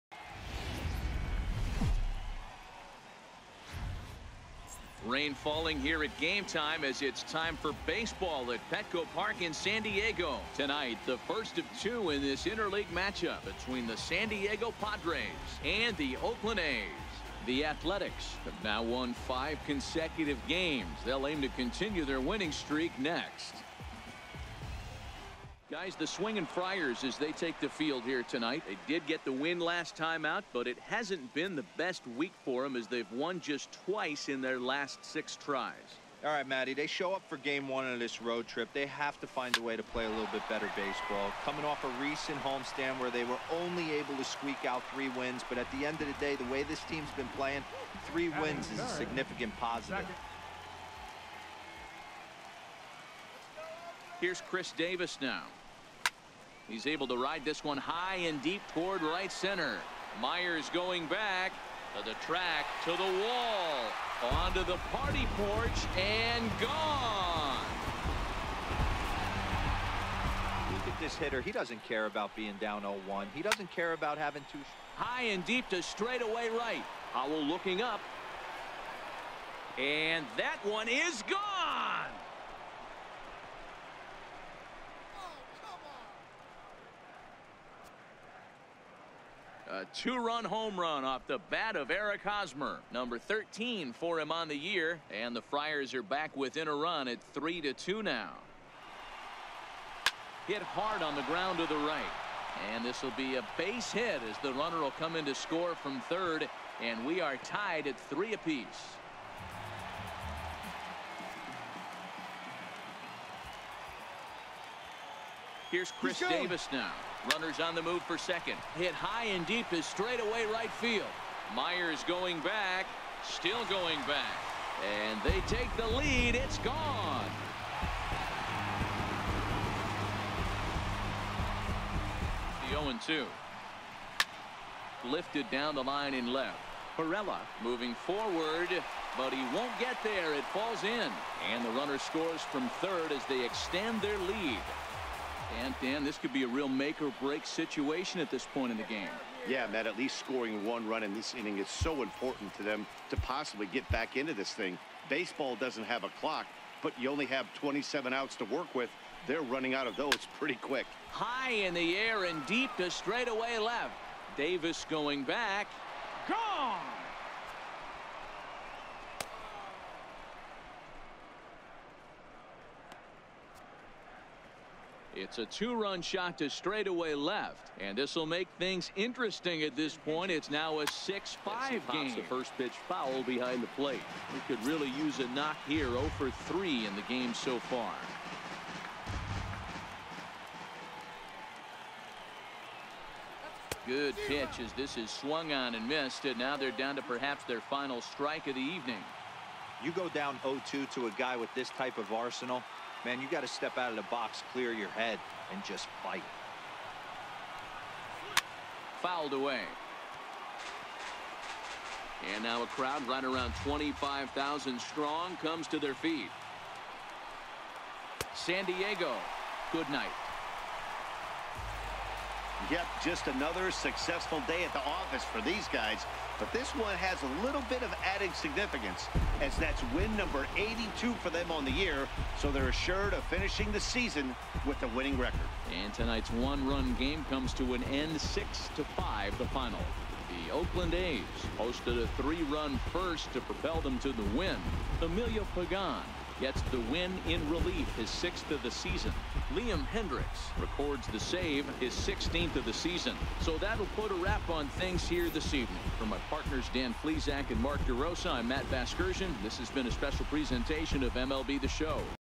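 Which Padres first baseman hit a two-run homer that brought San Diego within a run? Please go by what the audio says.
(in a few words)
Eric Hosmer.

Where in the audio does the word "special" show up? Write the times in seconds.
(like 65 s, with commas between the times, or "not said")
259 s.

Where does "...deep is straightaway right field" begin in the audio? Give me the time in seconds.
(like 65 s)
119 s.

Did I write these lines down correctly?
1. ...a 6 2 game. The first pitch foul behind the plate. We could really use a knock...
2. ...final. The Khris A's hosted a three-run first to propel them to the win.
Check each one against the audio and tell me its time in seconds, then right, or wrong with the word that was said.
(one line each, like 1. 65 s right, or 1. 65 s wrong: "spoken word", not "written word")
1. 180 s wrong: "5", not "2"
2. 239 s wrong: "Oakland", not "Khris".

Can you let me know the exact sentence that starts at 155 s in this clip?
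Baseball doesn't have a clock, but you only have 27 outs to work with.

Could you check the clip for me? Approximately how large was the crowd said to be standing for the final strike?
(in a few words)
25,000.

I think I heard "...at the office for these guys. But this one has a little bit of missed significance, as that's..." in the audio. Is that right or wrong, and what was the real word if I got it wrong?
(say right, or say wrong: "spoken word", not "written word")
wrong: "added", not "missed".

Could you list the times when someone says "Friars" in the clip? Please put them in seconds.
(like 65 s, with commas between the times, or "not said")
26 s, 95 s.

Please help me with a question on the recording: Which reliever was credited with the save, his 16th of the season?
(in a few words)
Liam Hendriks.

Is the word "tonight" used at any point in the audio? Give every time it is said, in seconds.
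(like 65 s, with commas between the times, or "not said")
10 s, 28 s, 235 s.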